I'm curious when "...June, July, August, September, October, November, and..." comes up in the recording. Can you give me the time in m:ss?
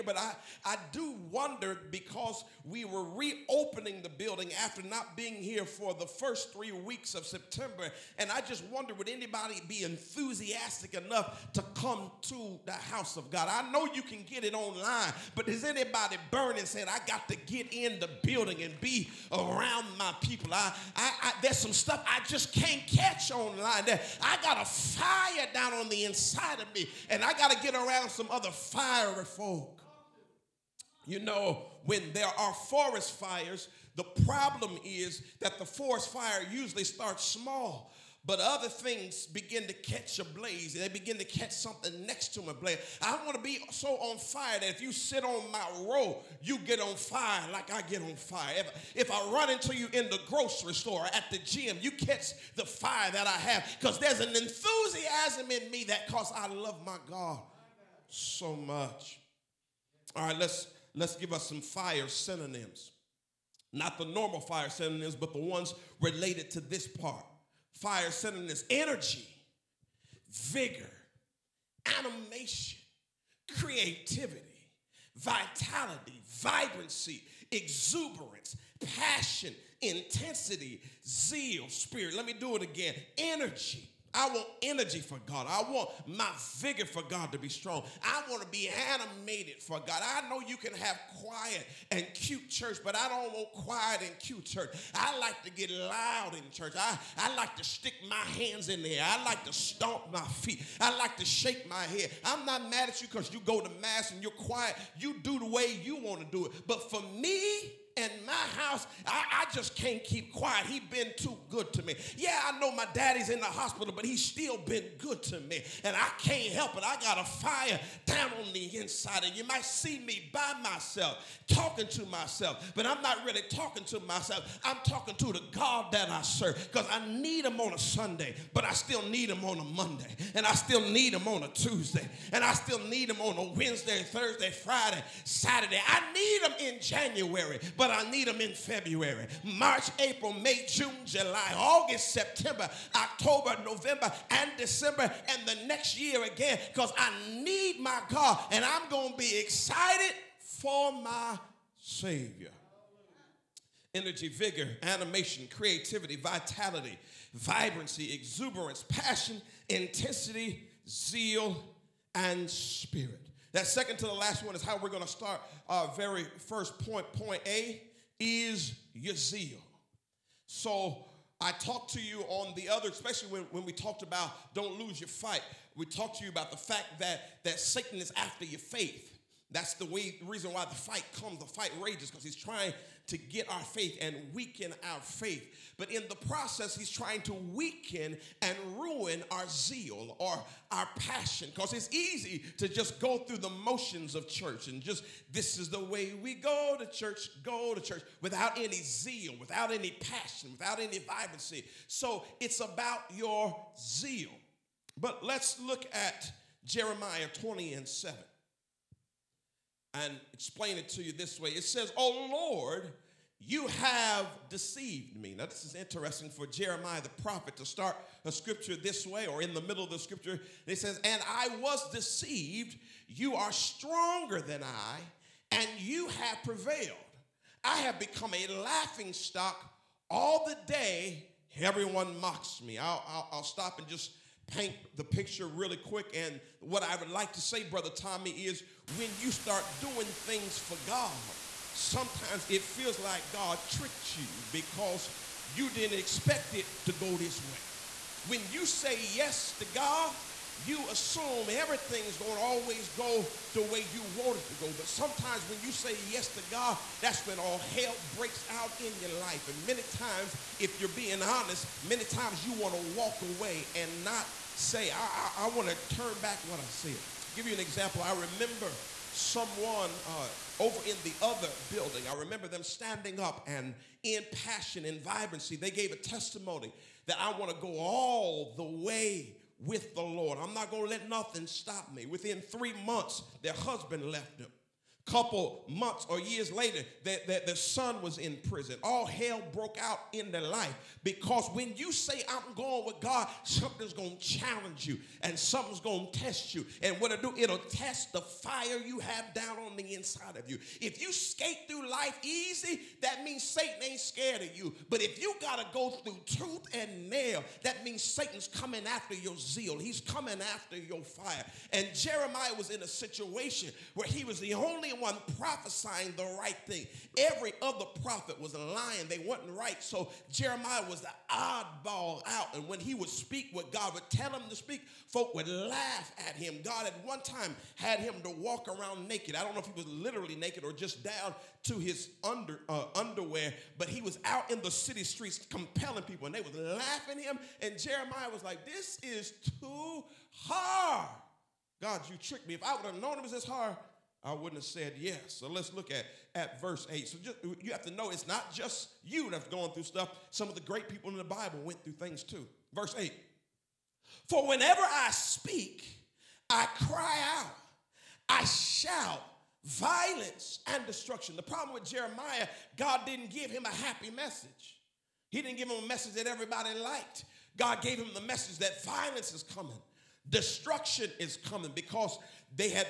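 2:20.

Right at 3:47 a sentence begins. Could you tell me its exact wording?
I have become a laughing stock all the day.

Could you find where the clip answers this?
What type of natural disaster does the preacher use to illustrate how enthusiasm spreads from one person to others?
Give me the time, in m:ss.
0:35.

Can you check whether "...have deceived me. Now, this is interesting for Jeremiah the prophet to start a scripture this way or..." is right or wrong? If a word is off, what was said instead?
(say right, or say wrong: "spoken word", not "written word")
right.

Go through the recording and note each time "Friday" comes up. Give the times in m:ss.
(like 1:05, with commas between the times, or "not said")
2:14.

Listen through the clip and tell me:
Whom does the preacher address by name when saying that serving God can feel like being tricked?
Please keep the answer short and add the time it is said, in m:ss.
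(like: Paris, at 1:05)
Brother Tommy, at 3:57.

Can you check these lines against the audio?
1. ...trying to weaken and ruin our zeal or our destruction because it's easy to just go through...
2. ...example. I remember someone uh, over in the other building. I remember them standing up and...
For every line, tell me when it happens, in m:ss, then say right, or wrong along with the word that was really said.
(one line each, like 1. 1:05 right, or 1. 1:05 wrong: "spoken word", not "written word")
1. 3:06 wrong: "passion", not "destruction"
2. 4:27 right.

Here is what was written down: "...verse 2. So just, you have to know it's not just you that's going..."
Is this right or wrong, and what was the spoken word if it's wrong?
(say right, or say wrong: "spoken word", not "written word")
wrong: "8", not "2".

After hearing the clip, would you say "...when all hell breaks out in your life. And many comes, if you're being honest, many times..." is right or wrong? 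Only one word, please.
wrong.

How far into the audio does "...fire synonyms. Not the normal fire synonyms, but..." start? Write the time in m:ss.
1:01.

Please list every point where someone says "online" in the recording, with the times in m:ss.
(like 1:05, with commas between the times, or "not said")
0:14, 0:23.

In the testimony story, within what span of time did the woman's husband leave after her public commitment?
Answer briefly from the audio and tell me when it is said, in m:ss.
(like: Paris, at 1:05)
3 months, at 4:42.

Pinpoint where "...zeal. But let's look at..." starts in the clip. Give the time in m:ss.
3:23.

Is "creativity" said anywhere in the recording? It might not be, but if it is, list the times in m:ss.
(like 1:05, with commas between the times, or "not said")
1:13, 2:35.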